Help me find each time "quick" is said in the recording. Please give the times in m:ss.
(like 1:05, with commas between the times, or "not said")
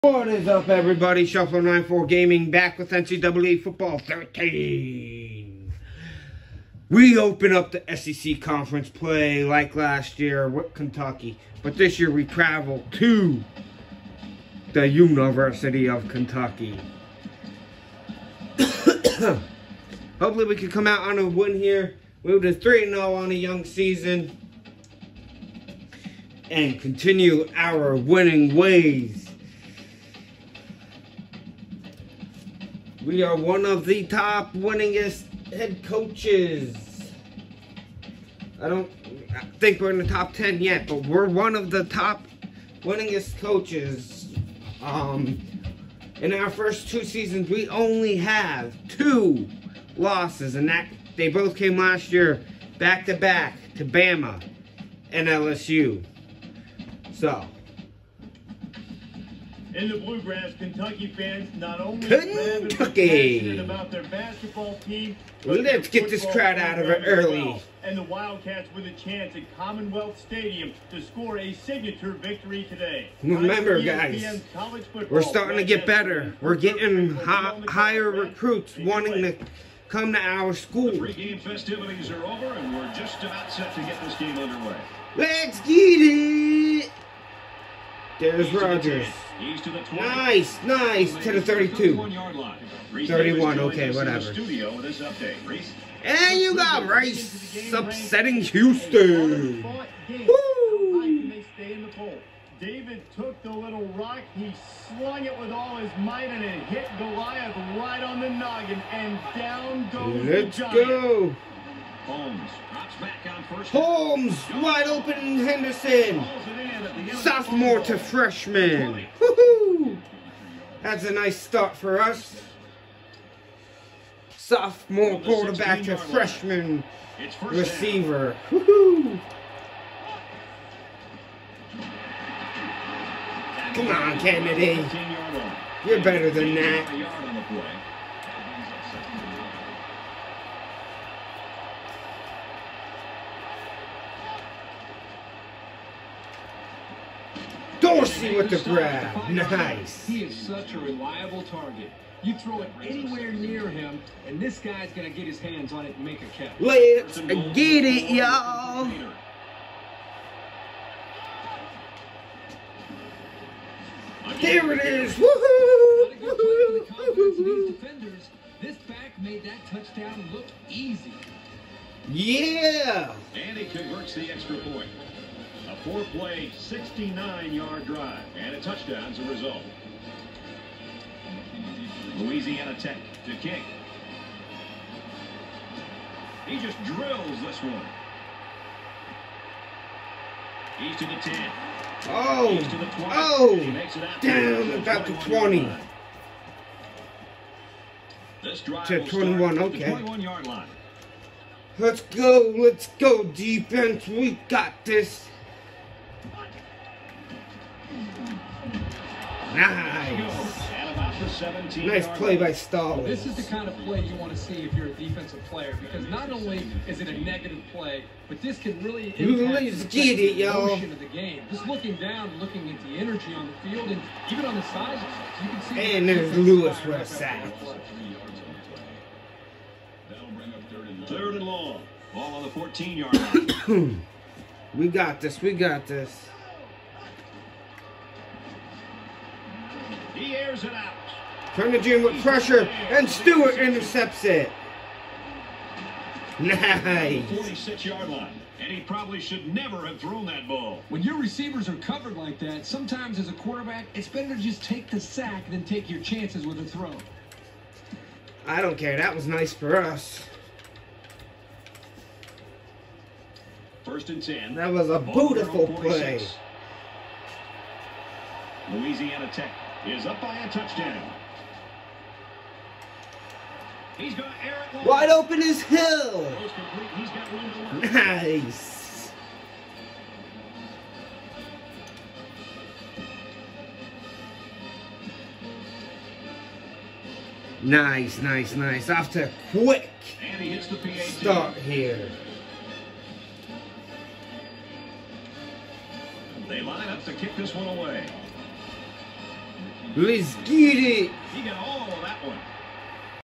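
4:49.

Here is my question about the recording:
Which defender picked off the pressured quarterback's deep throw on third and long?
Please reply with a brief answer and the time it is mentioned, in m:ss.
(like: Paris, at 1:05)
Stewart, at 4:03.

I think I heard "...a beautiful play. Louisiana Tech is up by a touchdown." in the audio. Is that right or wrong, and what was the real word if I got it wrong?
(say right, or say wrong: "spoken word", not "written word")
right.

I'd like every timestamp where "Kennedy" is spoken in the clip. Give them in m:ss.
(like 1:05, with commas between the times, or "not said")
2:14.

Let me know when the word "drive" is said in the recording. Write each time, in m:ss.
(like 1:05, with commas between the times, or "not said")
2:57, 3:18.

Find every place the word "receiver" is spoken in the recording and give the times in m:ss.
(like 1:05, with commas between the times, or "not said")
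2:07, 4:11.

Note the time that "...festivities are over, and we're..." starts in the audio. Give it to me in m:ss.
1:21.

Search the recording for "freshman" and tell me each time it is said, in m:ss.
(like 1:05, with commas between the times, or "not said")
1:57, 2:05.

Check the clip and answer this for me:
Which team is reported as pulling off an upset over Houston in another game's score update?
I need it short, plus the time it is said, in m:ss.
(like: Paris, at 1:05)
Rice, at 1:36.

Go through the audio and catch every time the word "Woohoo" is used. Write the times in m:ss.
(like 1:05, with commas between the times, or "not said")
1:59, 2:08, 2:45.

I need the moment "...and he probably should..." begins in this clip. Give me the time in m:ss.
4:08.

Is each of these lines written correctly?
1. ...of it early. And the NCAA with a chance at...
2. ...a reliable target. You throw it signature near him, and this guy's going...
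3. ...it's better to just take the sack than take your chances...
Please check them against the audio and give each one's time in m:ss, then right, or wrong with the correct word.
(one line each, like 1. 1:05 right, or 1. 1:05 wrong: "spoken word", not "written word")
1. 1:06 wrong: "Wildcats", not "NCAA"
2. 2:30 wrong: "anywhere", not "signature"
3. 4:13 right.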